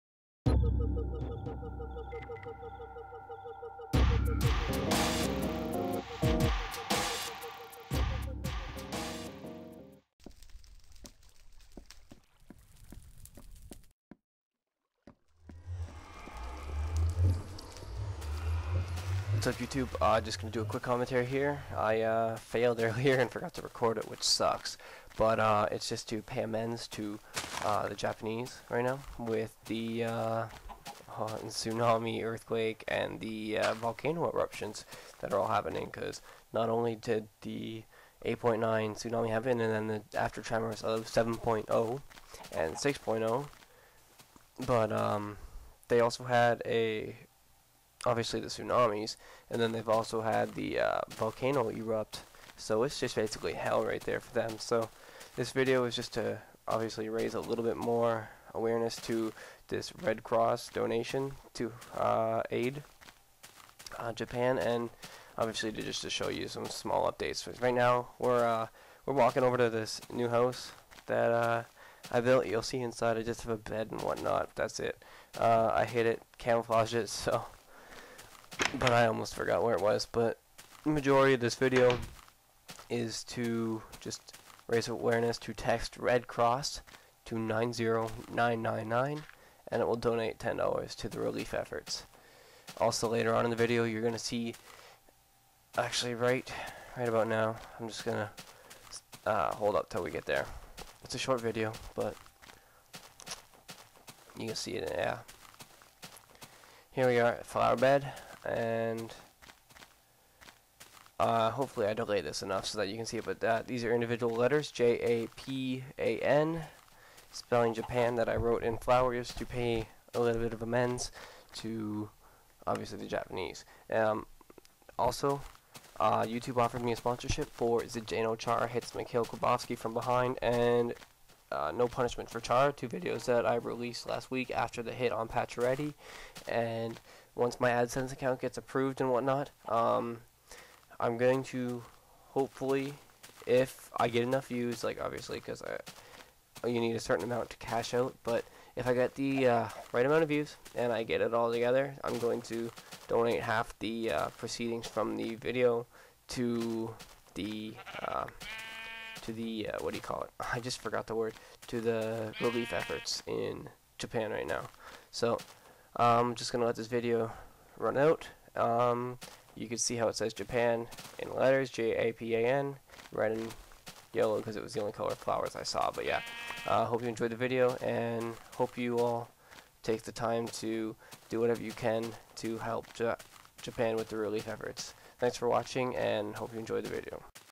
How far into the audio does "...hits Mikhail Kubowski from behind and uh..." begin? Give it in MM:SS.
02:08.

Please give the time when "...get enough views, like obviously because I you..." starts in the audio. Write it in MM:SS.
02:24.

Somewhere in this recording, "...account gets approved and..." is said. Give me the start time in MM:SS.
02:18.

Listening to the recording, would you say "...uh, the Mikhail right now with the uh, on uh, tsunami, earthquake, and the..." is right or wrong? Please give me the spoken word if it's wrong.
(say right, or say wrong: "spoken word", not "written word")
wrong: "Japanese", not "Mikhail".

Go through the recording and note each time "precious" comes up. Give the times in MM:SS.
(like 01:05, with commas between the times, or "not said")
not said.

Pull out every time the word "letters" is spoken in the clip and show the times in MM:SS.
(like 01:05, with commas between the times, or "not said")
01:54, 02:51.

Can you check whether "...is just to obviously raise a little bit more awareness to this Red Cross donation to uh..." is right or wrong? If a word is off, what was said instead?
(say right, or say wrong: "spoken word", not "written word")
right.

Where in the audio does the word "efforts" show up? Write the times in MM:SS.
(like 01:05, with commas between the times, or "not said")
01:31, 02:42, 03:04.